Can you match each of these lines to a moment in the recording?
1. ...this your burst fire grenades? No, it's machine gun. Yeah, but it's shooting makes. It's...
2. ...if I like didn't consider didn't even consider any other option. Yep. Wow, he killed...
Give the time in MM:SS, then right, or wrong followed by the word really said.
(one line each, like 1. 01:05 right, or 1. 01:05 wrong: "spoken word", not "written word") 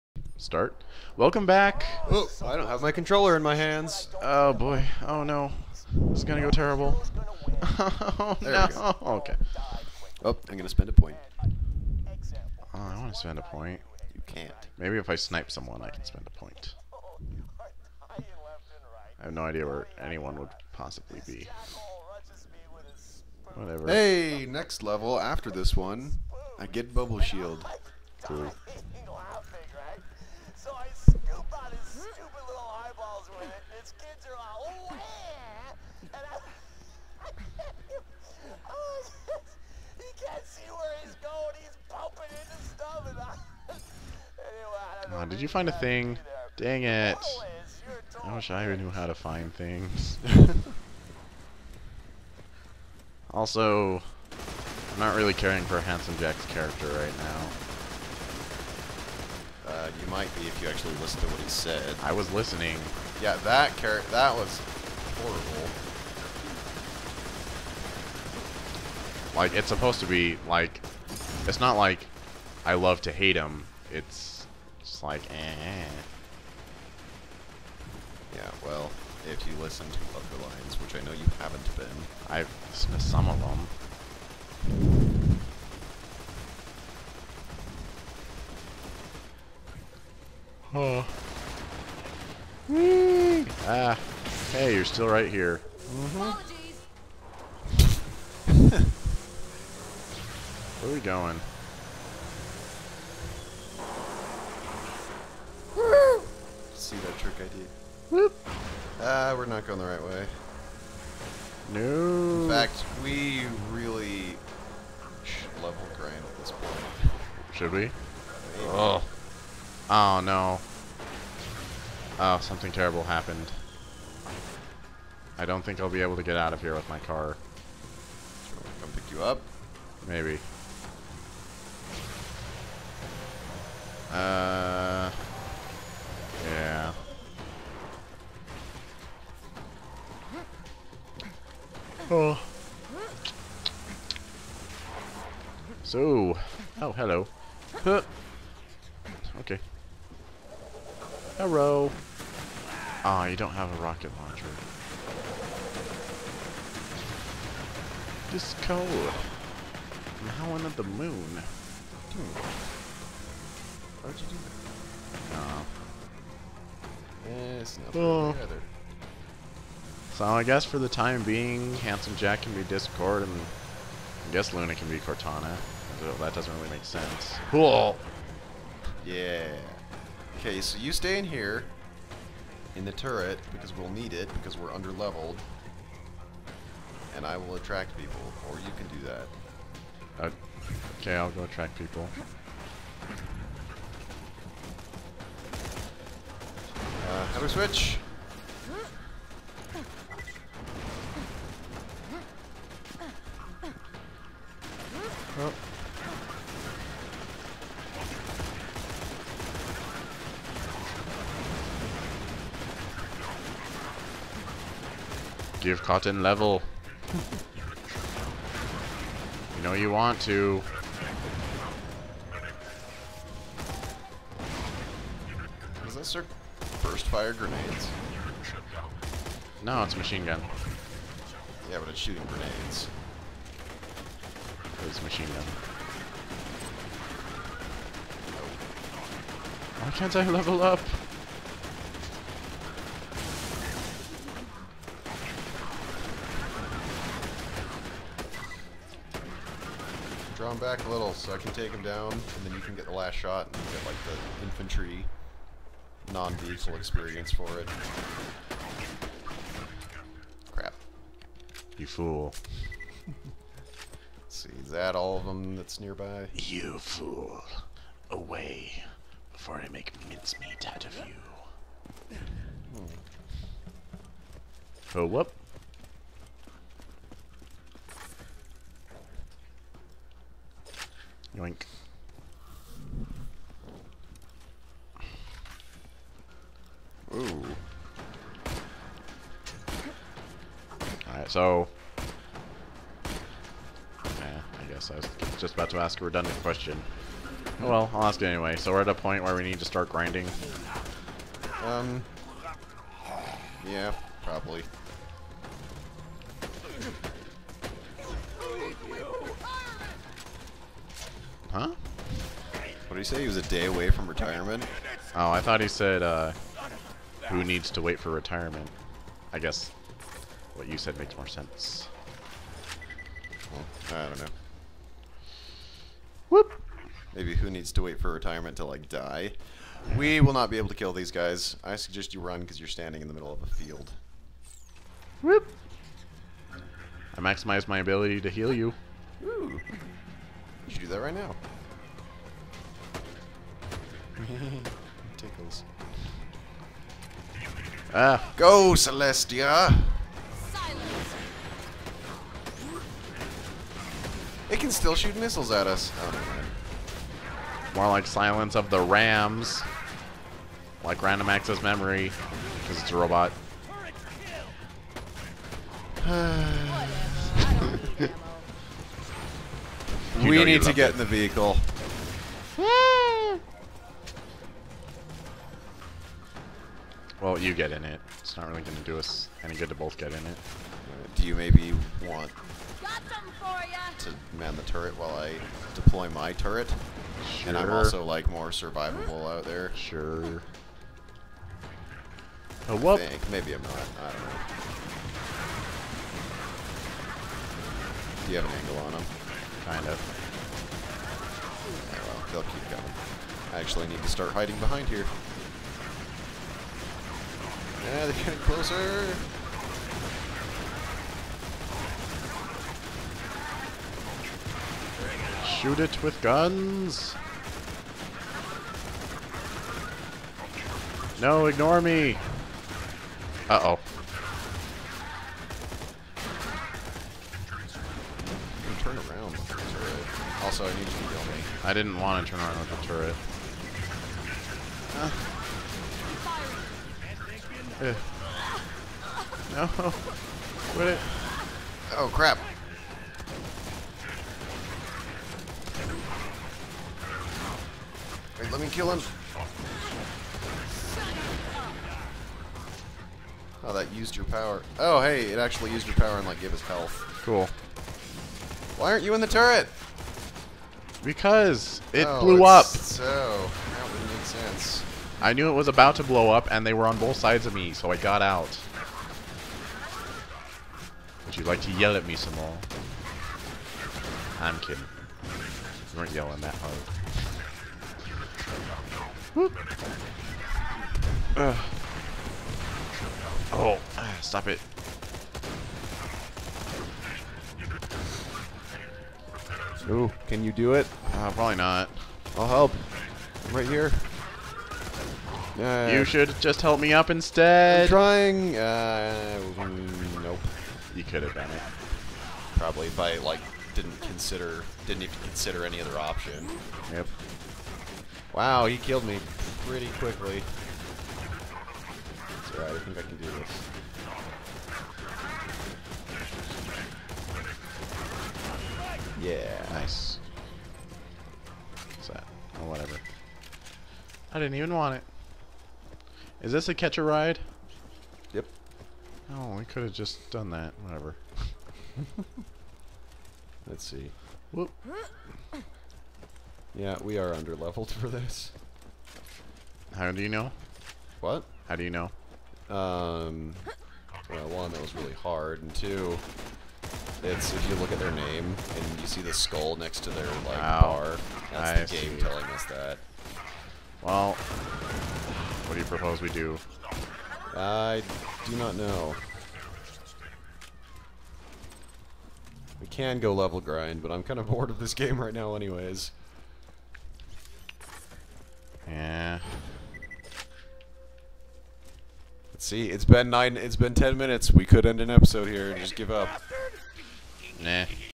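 1. 03:45 wrong: "grenades", not "makes"
2. 08:22 right.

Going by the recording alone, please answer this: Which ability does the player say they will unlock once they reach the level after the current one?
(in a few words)
Bubble shield.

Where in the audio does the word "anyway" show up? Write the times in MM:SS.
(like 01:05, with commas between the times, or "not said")
04:58, 09:25.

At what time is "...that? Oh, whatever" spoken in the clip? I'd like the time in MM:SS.
08:42.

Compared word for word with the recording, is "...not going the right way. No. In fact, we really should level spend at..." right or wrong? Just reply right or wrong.
wrong.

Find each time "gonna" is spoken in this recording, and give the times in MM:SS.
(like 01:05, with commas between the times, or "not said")
00:06, 00:10.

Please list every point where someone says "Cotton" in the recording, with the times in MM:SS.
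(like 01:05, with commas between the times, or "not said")
03:35.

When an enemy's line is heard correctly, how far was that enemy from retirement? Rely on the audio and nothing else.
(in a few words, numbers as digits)
A day.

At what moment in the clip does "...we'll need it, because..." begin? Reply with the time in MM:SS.
03:03.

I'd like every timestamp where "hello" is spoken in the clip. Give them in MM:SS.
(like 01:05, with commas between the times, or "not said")
02:26, 02:31.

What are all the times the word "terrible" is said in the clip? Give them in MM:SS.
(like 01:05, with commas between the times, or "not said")
00:06, 02:02.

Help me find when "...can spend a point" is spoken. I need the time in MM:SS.
00:15.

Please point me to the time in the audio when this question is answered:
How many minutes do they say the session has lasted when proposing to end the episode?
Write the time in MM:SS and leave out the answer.
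09:33.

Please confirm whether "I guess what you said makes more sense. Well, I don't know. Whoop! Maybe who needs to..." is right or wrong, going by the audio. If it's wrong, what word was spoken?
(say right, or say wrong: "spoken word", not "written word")
right.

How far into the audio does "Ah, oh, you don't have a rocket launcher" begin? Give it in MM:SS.
02:33.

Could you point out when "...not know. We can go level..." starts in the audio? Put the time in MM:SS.
09:18.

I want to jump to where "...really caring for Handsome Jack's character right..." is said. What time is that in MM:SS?
00:55.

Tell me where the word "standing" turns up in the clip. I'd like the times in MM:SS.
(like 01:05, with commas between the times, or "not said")
05:32.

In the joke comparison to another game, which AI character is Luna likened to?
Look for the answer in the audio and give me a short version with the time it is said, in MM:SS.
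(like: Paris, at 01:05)
Cortana, at 02:54.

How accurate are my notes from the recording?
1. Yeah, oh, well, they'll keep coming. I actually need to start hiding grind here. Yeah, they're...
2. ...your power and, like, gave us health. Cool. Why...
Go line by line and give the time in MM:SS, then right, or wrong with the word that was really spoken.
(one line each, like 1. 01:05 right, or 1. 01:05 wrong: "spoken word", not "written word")
1. 06:41 wrong: "behind", not "grind"
2. 07:35 right.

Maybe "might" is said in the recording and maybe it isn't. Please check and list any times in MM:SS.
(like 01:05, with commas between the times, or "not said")
01:00.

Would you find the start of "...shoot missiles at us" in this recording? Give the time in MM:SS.
05:54.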